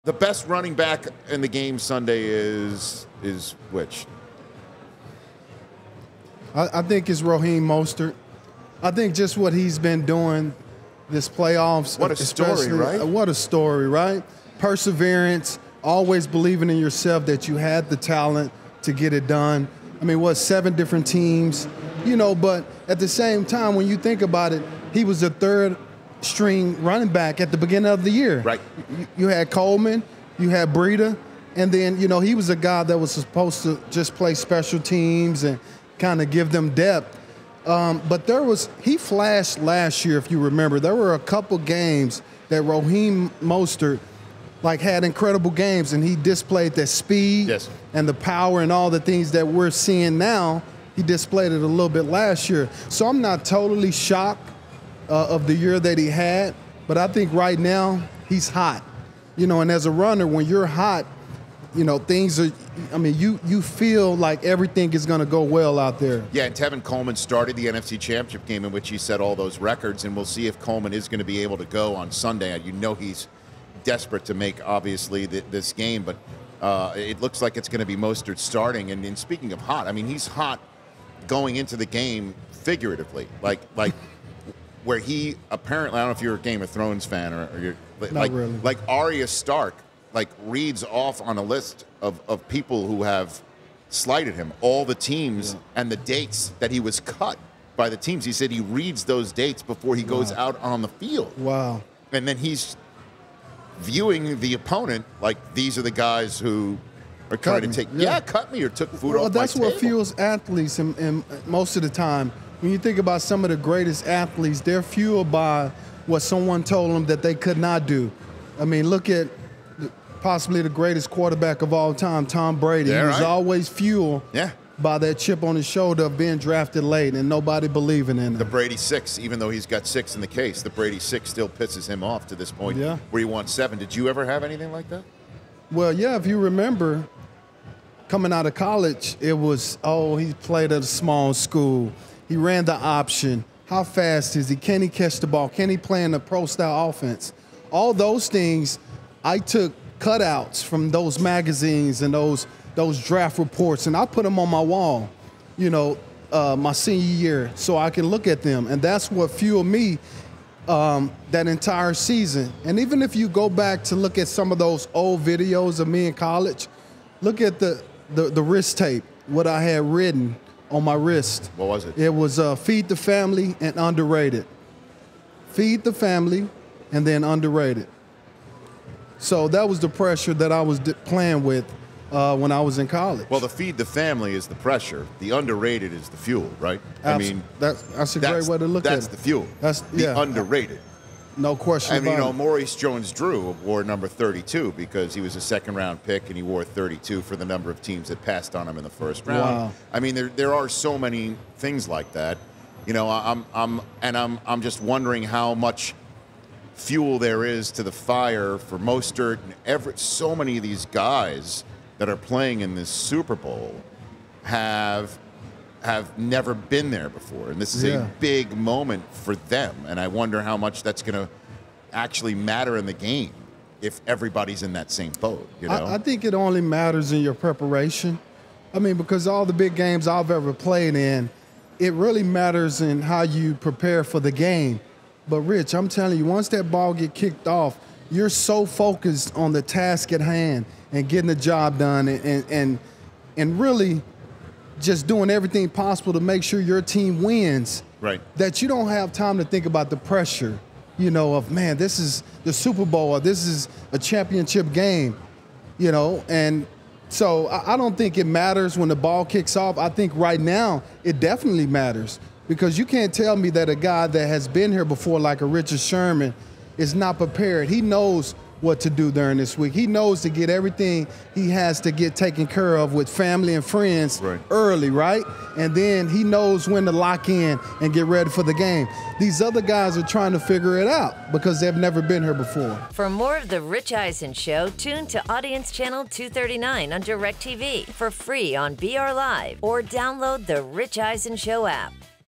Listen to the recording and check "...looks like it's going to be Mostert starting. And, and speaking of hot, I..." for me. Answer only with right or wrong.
right.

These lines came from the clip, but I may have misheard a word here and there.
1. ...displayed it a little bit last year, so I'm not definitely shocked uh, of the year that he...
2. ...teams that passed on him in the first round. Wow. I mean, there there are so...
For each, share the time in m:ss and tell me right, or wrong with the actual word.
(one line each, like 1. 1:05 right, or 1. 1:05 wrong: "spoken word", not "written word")
1. 0:51 wrong: "totally", not "definitely"
2. 3:17 right.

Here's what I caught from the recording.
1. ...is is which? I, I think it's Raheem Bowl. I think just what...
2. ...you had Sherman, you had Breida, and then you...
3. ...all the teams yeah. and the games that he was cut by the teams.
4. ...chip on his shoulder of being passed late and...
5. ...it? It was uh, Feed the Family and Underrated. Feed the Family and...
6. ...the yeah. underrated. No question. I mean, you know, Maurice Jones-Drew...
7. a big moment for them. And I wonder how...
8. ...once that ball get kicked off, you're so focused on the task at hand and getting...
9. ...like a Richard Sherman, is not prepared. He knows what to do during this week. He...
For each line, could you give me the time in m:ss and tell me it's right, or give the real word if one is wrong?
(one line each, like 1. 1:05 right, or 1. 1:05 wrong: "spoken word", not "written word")
1. 0:02 wrong: "Mostert", not "Bowl"
2. 0:29 wrong: "Coleman", not "Sherman"
3. 1:34 wrong: "dates", not "games"
4. 2:05 wrong: "drafted", not "passed"
5. 2:51 right
6. 3:09 right
7. 3:38 right
8. 3:56 right
9. 4:25 right.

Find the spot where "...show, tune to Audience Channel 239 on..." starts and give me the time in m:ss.
4:44.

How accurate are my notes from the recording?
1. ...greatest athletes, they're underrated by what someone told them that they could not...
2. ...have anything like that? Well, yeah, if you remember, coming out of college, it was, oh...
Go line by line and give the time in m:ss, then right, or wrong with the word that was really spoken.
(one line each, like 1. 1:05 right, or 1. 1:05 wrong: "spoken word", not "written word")
1. 1:53 wrong: "fueled", not "underrated"
2. 2:14 right.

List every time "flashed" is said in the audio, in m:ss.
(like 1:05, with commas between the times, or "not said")
0:38.